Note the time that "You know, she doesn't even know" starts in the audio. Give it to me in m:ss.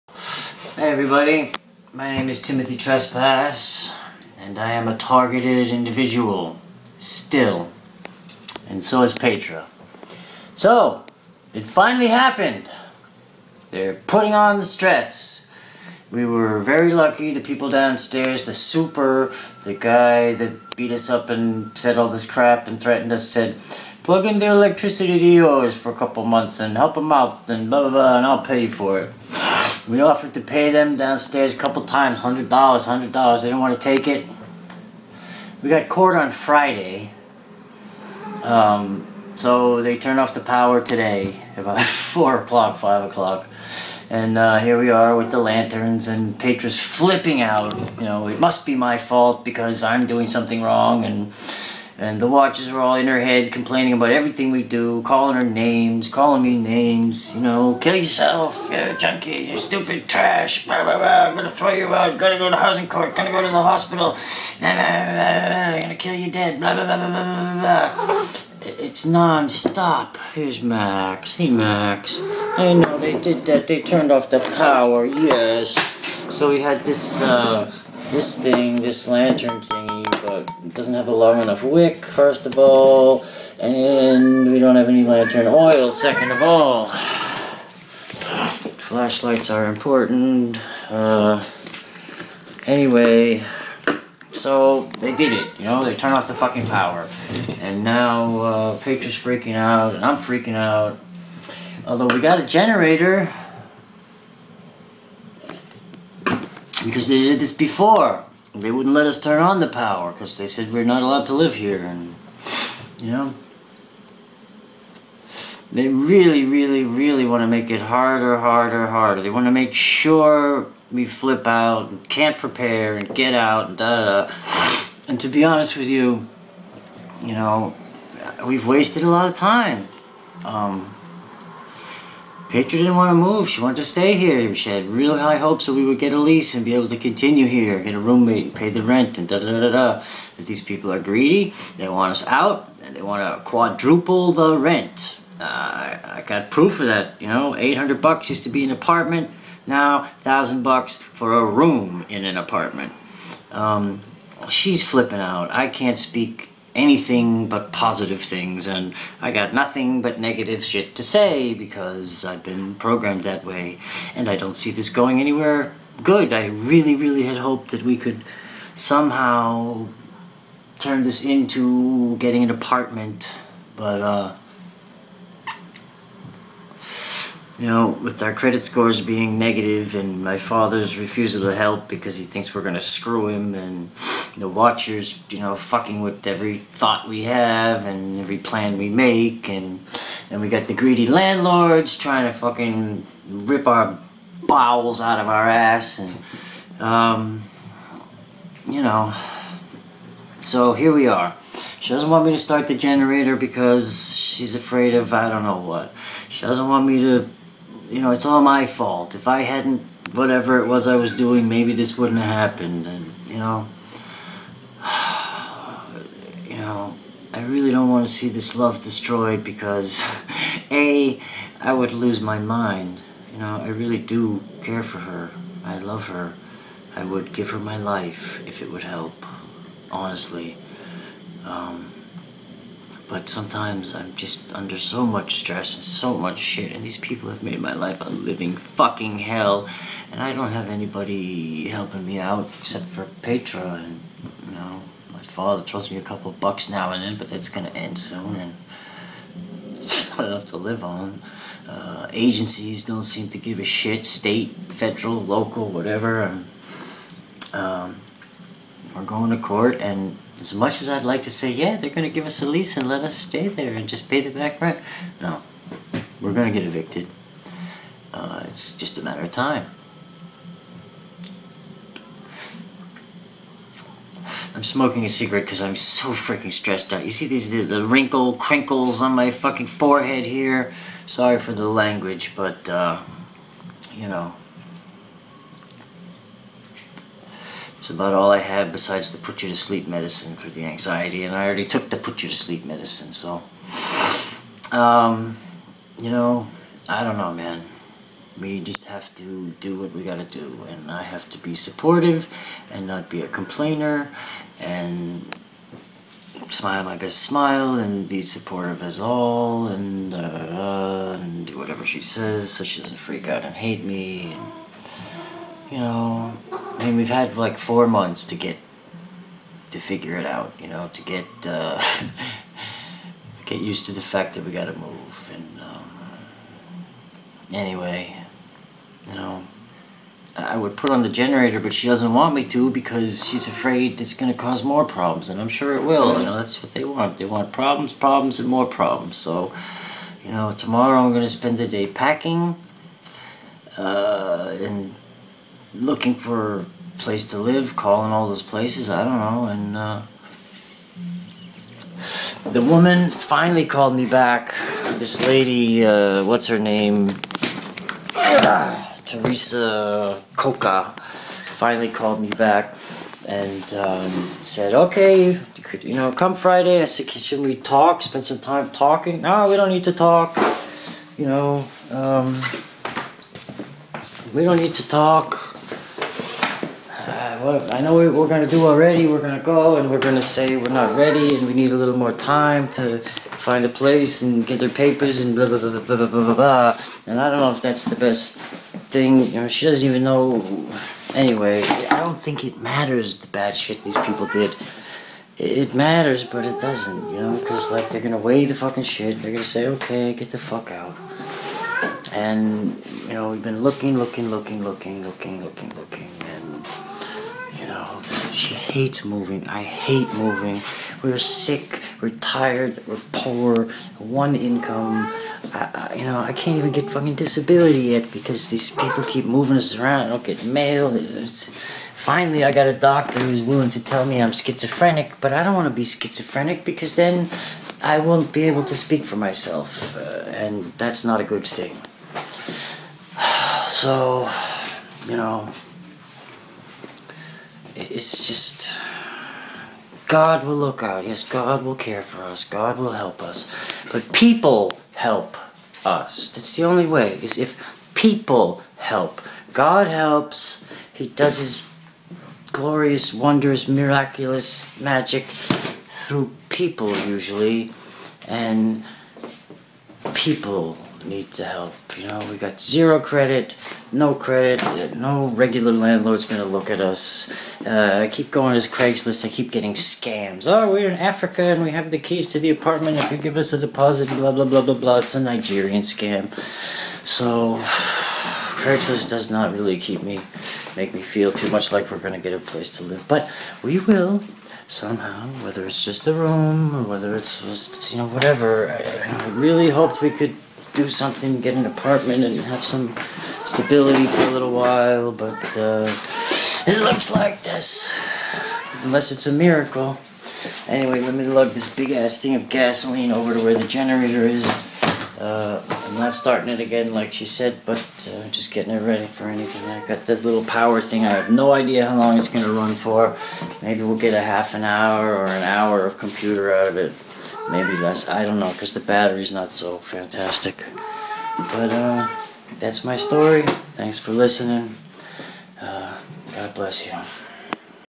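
6:29.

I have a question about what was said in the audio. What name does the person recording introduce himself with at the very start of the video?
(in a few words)
Timothy Trespas.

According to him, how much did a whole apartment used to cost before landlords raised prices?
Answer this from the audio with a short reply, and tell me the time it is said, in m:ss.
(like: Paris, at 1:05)
$800, at 2:27.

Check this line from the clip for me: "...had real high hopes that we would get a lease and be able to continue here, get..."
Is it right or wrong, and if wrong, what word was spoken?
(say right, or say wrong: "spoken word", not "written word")
right.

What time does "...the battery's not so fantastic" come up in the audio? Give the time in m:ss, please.
8:38.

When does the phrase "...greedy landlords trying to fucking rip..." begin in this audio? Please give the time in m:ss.
3:10.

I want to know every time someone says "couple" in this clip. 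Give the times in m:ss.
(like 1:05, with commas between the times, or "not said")
0:25, 0:31, 4:06.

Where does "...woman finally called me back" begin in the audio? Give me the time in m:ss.
5:52.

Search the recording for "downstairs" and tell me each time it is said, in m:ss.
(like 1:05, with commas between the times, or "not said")
0:17, 0:30.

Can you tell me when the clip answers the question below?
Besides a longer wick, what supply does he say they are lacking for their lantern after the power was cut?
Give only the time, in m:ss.
1:25.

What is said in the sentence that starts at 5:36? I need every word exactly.
You know, that's what they want.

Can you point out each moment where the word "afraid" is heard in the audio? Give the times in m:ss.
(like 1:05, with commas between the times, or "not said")
3:24, 5:33.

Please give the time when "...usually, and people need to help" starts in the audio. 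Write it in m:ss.
7:37.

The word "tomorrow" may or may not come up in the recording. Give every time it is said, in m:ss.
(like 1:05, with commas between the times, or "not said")
5:40.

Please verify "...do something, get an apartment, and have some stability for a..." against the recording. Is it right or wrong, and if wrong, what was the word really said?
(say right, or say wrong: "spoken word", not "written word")
right.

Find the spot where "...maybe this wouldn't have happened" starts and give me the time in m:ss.
3:31.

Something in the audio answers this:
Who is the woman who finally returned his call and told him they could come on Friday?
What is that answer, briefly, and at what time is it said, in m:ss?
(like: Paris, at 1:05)
Teresa Coca, at 5:59.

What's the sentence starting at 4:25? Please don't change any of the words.
No, we're going to get evicted.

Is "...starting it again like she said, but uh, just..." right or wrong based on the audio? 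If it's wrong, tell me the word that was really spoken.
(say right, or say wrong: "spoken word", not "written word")
right.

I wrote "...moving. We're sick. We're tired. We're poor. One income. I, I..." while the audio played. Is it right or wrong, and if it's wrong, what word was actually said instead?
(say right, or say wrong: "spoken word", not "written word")
right.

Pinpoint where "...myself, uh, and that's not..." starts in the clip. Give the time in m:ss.
7:09.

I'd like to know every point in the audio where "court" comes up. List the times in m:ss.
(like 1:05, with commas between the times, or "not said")
0:35, 1:02, 4:19.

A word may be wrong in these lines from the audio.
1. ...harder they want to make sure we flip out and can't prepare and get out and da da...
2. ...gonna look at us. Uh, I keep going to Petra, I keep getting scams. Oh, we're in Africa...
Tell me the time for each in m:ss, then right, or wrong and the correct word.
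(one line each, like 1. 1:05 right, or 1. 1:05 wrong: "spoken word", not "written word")
1. 1:58 right
2. 7:46 wrong: "Craigslist", not "Petra".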